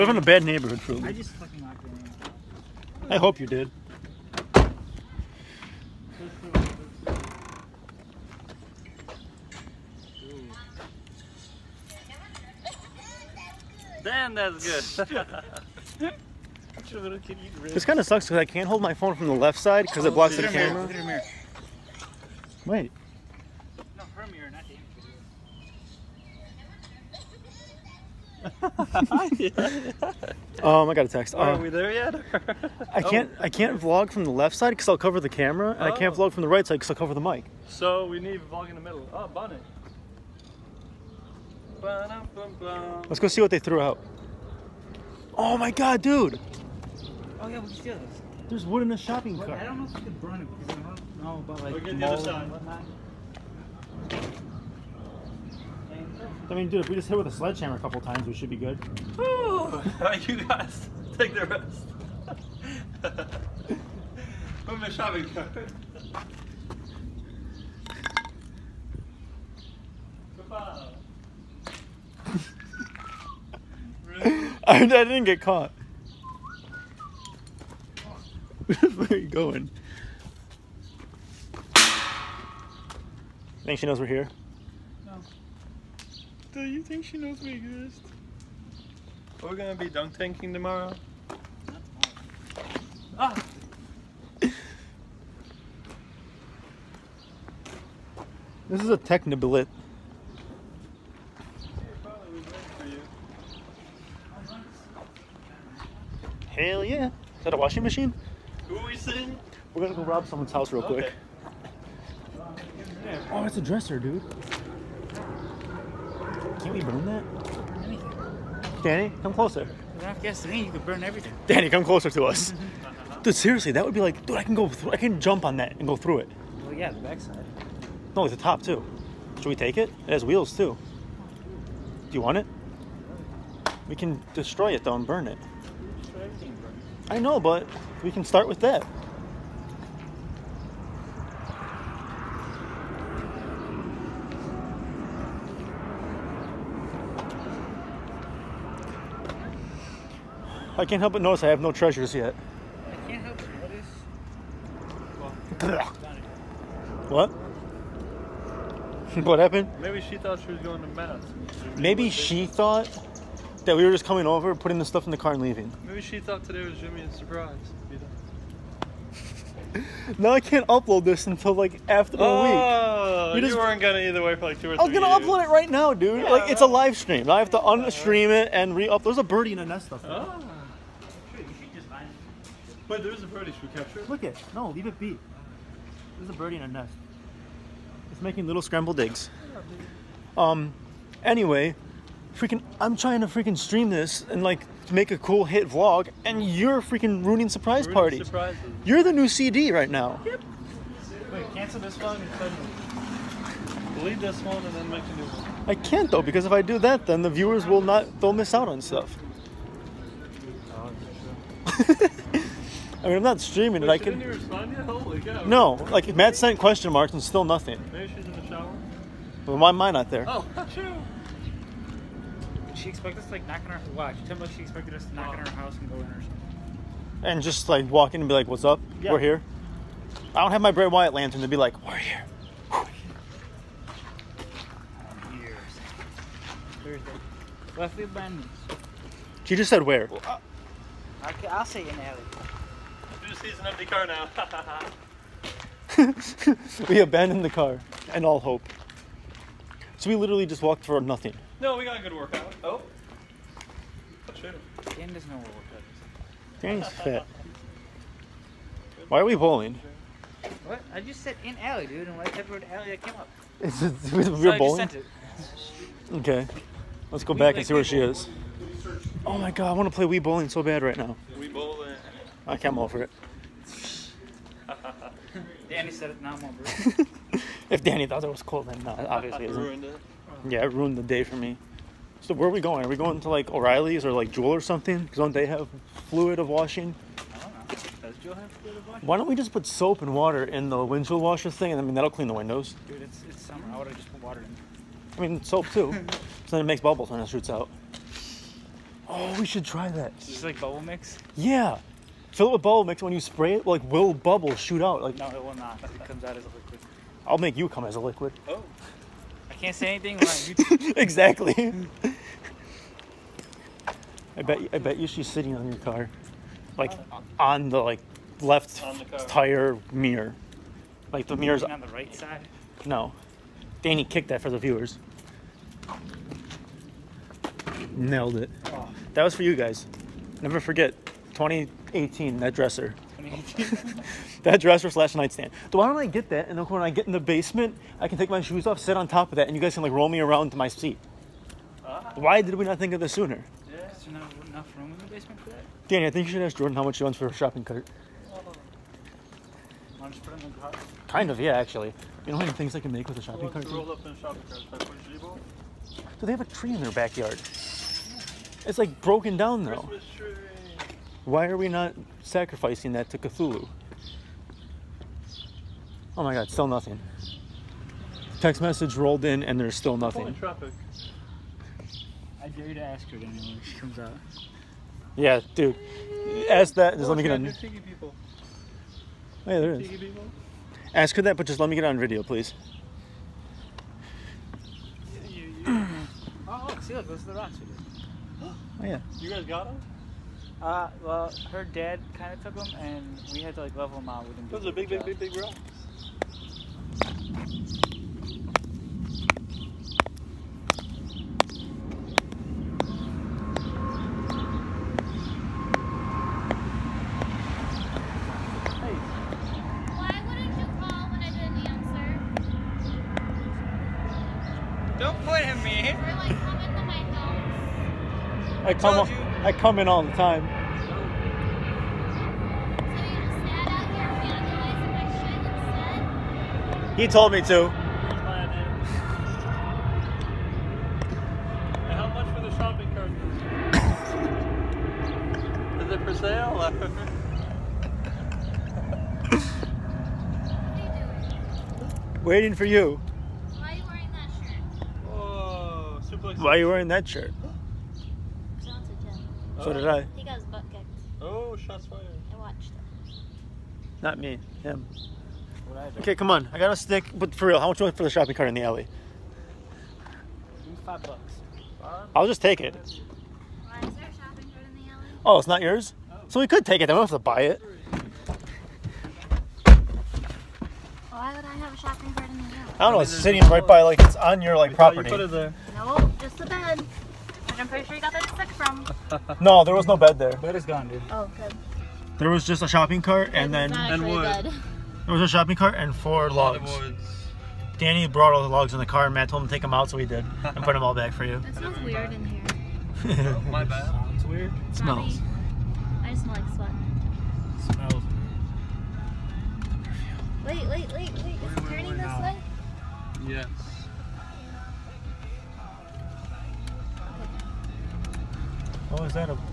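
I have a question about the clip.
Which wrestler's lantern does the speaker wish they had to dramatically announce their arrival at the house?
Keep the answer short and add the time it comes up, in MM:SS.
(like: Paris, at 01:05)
Bray Wyatt, at 03:50.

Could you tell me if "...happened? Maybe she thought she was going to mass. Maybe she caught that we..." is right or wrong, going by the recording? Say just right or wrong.
wrong.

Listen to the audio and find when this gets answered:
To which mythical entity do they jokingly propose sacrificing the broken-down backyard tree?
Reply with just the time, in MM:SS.
06:03.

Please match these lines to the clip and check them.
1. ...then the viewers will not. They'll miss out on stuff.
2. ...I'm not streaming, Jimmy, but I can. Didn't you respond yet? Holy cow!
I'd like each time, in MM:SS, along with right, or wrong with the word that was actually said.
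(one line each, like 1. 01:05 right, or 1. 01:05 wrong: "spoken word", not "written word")
1. 03:27 right
2. 03:33 wrong: "Wait", not "Jimmy".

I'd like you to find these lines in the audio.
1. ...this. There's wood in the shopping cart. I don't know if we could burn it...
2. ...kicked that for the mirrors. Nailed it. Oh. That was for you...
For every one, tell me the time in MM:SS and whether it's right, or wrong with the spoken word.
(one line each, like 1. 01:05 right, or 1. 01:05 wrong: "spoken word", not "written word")
1. 00:47 right
2. 05:24 wrong: "viewers", not "mirrors".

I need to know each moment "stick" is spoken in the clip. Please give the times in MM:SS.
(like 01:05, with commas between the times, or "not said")
07:36, 07:58.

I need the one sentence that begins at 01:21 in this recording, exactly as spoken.
I think she knows we're here?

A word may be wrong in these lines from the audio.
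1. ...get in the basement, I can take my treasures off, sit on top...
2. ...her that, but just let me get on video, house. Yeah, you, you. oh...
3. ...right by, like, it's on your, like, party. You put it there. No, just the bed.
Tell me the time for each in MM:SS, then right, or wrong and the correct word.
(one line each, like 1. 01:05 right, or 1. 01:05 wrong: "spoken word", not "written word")
1. 05:36 wrong: "shoes", not "treasures"
2. 06:21 wrong: "please", not "house"
3. 07:53 wrong: "property", not "party".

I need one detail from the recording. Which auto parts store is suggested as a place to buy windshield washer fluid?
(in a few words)
O'Reilly's.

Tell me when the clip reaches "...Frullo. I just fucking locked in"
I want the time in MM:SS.
00:00.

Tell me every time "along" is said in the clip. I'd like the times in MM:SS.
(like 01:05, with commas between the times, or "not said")
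not said.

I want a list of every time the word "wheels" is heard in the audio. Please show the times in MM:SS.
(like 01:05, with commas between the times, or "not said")
02:10.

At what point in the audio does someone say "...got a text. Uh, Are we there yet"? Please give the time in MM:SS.
00:30.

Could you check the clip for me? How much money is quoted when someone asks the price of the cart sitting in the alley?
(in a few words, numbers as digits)
$5.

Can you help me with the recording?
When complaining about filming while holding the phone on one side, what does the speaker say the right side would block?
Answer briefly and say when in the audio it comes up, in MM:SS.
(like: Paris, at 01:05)
the mic, at 00:37.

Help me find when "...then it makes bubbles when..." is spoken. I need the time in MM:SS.
04:56.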